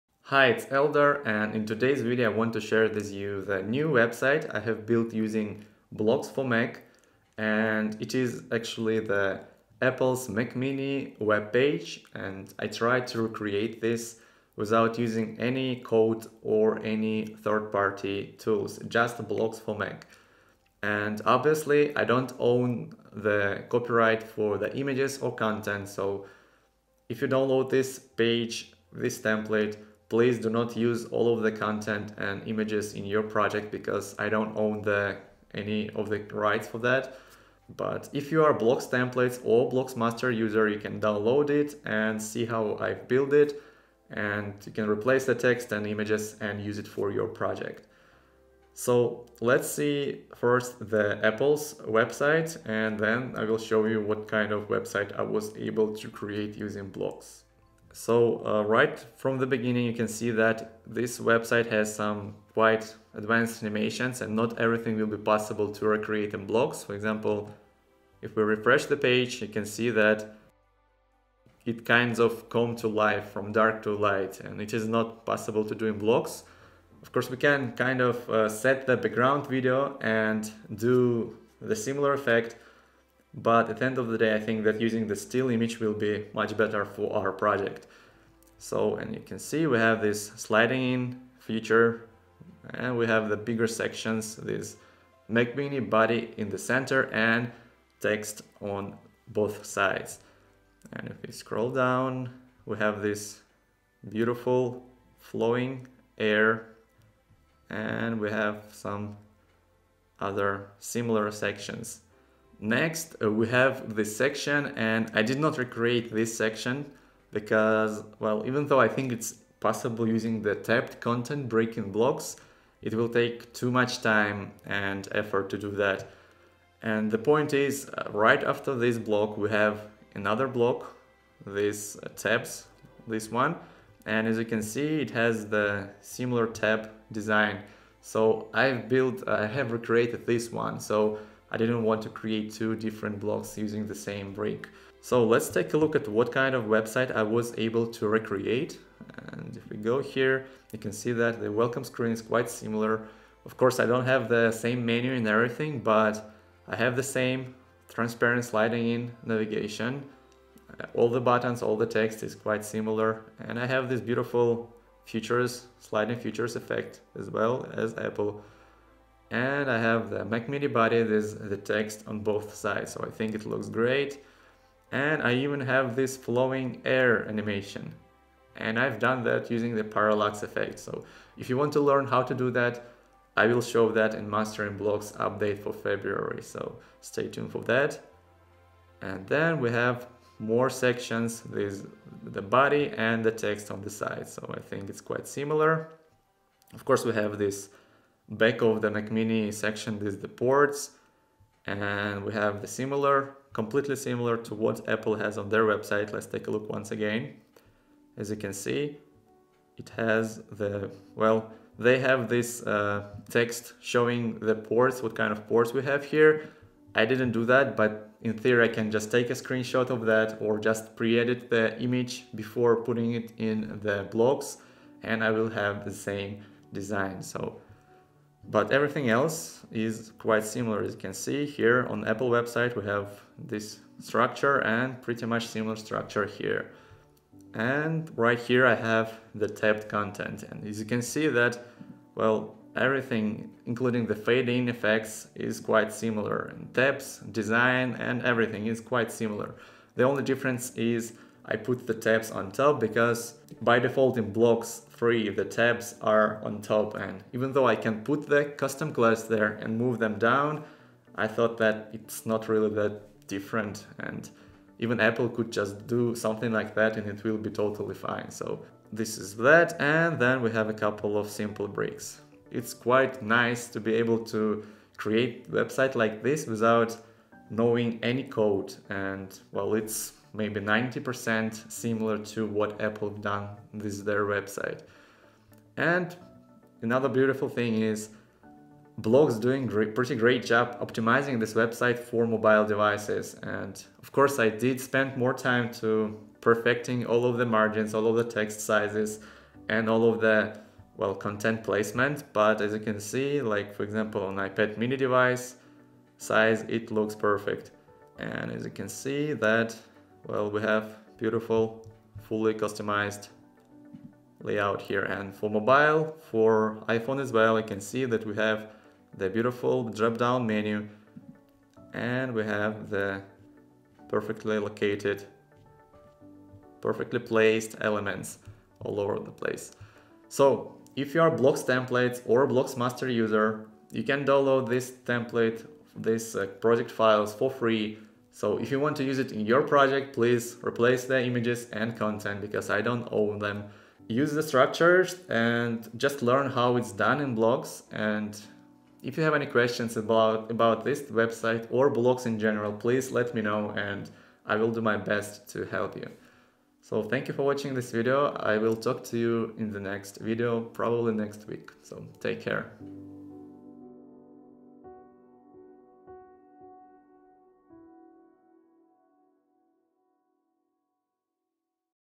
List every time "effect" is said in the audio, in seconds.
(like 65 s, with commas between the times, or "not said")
82 s, 166 s, 180 s, 244 s.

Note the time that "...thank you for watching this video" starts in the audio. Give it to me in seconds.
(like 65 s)
357 s.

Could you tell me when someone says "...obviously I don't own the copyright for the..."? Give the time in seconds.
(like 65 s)
21 s.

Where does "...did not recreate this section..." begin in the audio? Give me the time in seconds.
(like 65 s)
115 s.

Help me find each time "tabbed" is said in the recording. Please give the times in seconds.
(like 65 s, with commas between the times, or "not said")
120 s, 239 s.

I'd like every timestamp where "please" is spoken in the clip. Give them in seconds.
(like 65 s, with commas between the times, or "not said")
30 s, 340 s, 352 s.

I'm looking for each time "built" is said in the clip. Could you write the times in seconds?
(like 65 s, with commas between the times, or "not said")
4 s, 43 s, 138 s.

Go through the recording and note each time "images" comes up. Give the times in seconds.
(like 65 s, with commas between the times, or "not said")
24 s, 32 s, 45 s, 85 s, 221 s, 341 s.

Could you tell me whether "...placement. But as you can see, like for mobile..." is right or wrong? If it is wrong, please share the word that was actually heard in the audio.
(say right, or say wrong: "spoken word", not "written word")
wrong: "example", not "mobile".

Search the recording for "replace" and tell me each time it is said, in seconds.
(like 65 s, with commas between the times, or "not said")
44 s, 340 s.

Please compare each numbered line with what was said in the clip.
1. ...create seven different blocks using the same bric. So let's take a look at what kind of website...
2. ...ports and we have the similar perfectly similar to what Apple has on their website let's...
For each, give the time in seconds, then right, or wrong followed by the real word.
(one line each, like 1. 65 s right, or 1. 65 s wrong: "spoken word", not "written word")
1. 142 s wrong: "two", not "seven"
2. 200 s wrong: "completely", not "perfectly".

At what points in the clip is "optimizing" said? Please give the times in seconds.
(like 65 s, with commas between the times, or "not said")
290 s.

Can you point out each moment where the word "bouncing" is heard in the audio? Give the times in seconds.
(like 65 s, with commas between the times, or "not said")
not said.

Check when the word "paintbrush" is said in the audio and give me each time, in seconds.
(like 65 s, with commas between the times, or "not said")
not said.